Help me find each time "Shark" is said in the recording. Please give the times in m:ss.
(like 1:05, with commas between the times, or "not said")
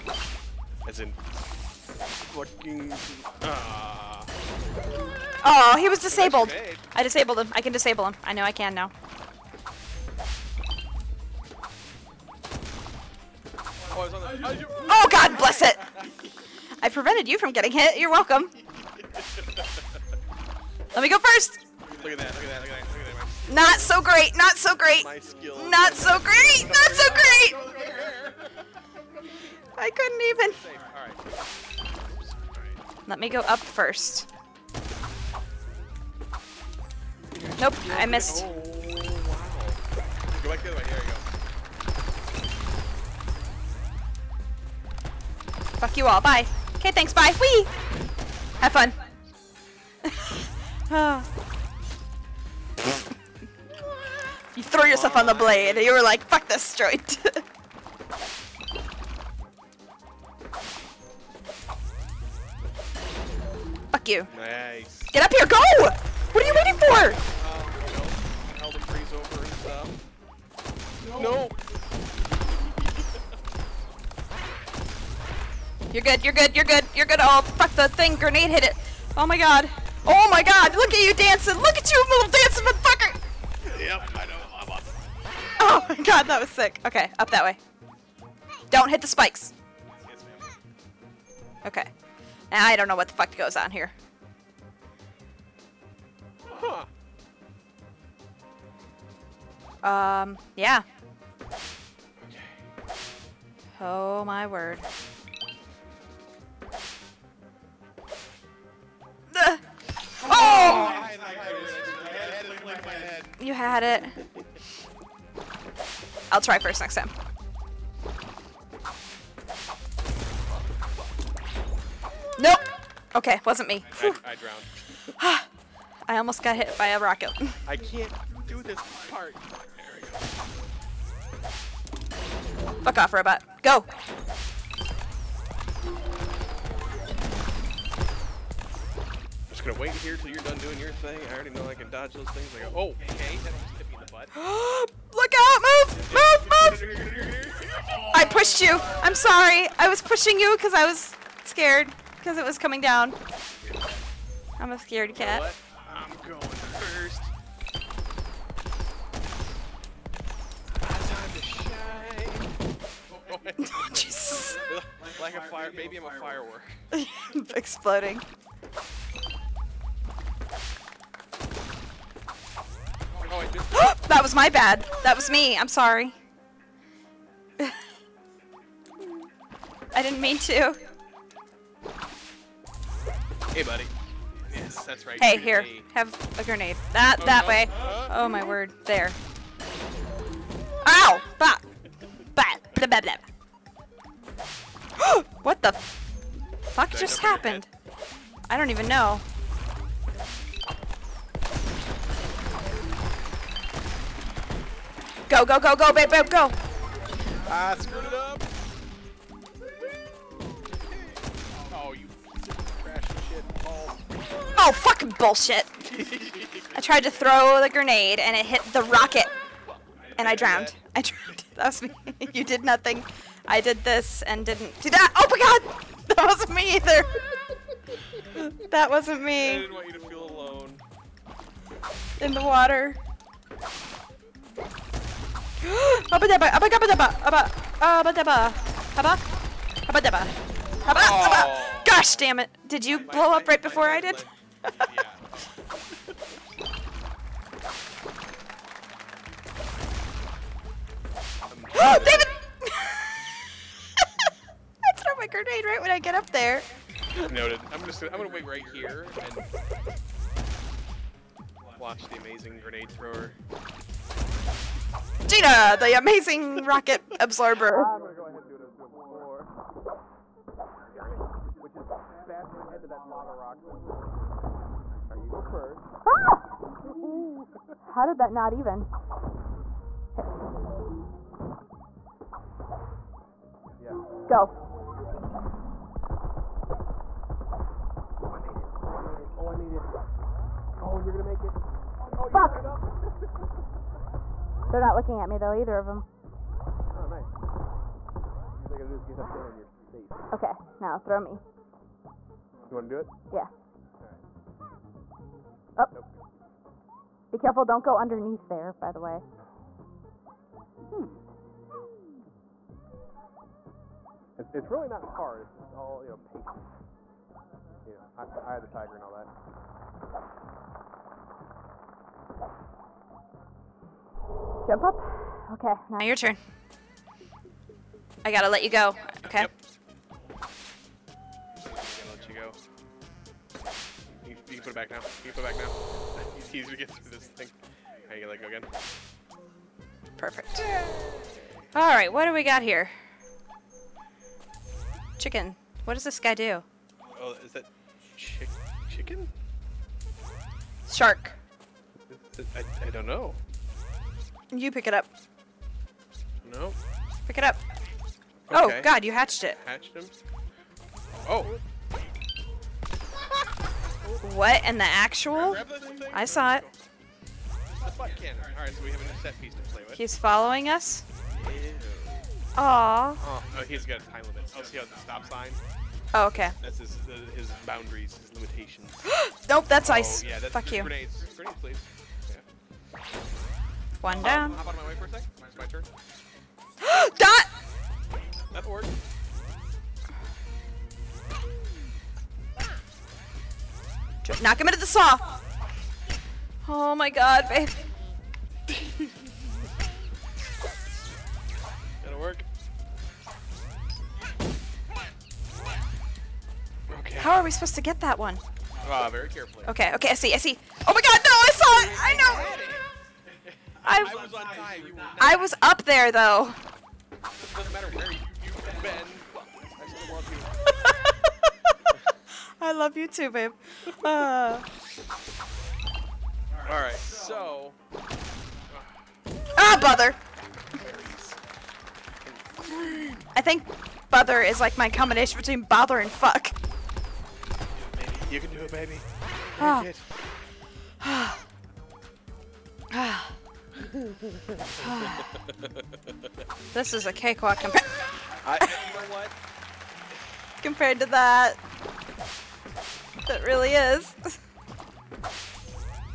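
5:50.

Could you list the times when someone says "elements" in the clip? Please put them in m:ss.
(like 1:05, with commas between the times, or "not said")
not said.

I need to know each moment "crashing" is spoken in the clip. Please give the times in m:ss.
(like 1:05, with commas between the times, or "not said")
3:32.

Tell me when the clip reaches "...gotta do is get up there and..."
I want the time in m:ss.
4:58.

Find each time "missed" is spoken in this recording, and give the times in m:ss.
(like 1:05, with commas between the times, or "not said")
0:38.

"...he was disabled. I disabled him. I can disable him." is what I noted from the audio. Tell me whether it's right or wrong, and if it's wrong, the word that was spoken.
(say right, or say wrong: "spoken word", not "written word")
right.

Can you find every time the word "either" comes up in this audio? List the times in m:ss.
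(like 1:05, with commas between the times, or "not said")
3:46, 4:55.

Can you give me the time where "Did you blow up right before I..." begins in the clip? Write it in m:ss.
4:02.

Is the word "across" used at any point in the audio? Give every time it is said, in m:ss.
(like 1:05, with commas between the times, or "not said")
not said.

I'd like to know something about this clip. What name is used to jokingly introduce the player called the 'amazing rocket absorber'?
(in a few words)
Gina.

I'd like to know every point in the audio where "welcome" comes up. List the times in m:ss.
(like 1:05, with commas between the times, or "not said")
0:18.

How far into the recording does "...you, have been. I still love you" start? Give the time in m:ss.
6:58.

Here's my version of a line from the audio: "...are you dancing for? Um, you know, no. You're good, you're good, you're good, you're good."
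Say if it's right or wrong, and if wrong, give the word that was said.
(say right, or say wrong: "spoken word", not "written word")
wrong: "waiting", not "dancing".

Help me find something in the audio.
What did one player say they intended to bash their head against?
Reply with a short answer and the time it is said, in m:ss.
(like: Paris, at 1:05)
Lava rock, at 4:33.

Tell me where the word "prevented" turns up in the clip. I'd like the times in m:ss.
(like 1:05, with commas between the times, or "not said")
0:16.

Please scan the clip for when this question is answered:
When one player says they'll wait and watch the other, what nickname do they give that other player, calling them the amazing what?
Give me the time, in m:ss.
4:22.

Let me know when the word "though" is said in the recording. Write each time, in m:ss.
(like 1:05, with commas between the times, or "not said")
4:55, 6:56.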